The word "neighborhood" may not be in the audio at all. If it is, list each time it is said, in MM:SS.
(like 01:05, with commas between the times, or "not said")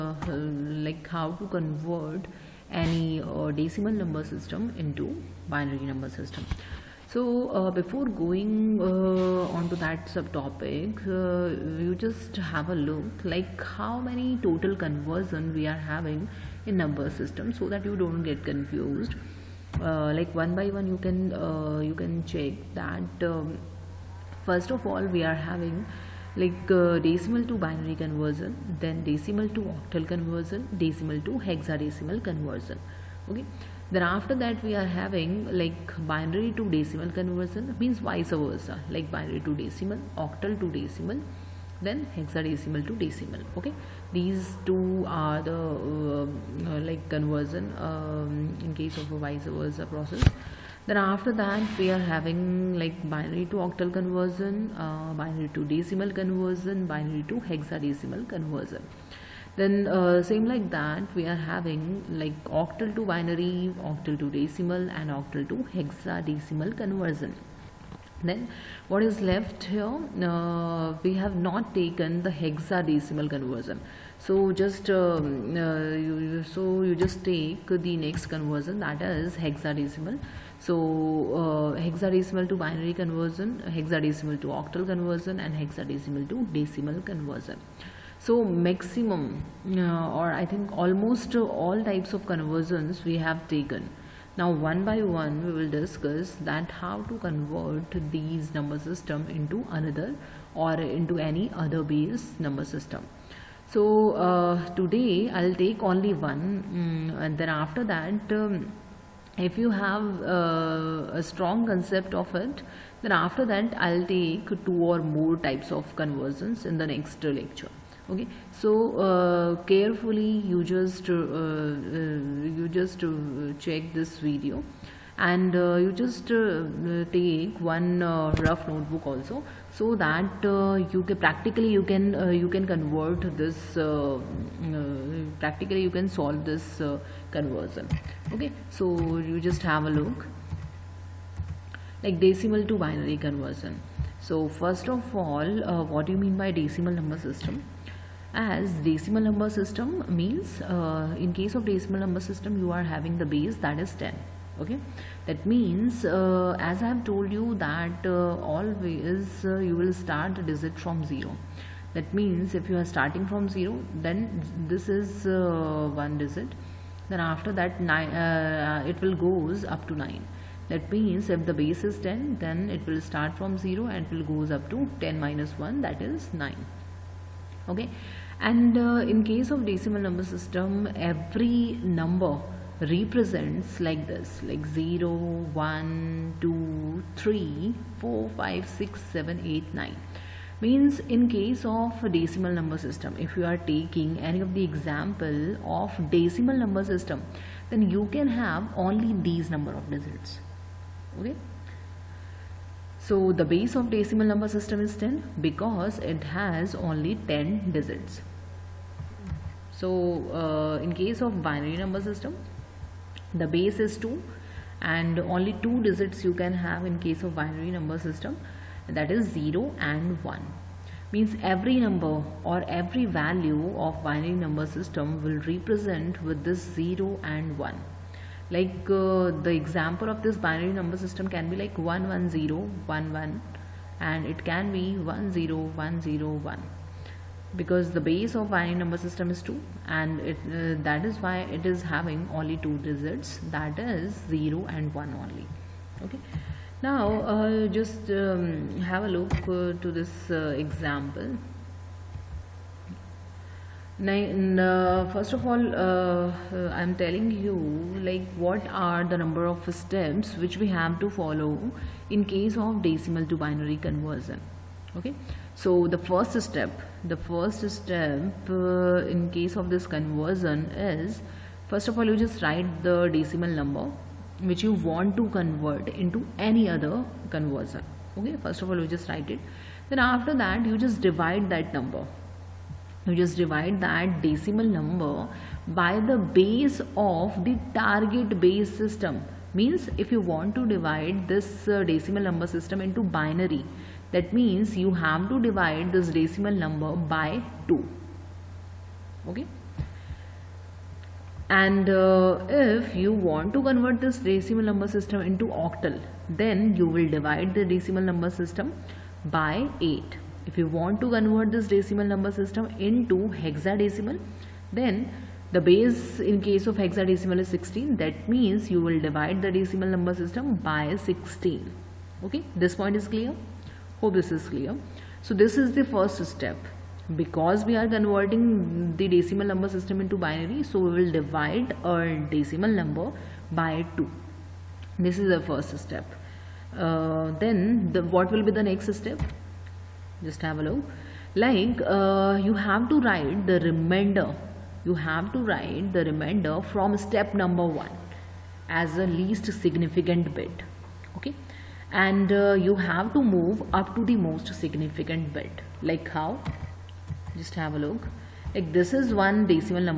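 not said.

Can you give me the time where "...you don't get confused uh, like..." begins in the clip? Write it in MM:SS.
00:17.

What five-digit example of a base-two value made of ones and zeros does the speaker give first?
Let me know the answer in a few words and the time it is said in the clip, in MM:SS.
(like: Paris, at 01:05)
11011, at 03:51.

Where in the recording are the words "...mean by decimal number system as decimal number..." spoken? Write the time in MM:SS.
02:26.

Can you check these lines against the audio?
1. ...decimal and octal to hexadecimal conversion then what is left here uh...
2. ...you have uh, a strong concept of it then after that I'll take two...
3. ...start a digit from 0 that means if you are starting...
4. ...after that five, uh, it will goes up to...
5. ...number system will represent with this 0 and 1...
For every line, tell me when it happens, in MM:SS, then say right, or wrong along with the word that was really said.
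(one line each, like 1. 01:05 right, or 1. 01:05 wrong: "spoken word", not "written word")
1. 01:04 right
2. 01:49 right
3. 02:39 right
4. 02:47 wrong: "nine", not "five"
5. 03:44 right.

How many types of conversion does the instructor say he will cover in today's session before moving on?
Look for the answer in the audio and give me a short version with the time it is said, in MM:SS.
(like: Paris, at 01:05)
1, at 01:45.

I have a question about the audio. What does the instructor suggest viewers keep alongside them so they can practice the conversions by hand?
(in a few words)
Rough notebook.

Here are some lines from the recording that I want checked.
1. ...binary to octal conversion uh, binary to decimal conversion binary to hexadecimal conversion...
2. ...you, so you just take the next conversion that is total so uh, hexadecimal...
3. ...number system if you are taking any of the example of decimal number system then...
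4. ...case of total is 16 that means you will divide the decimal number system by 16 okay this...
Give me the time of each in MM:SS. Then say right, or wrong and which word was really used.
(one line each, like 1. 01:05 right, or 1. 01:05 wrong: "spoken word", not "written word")
1. 00:53 right
2. 01:15 wrong: "hexadecimal", not "total"
3. 03:12 right
4. 05:16 wrong: "hexadecimal", not "total".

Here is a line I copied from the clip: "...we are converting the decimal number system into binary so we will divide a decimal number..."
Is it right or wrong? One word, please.
right.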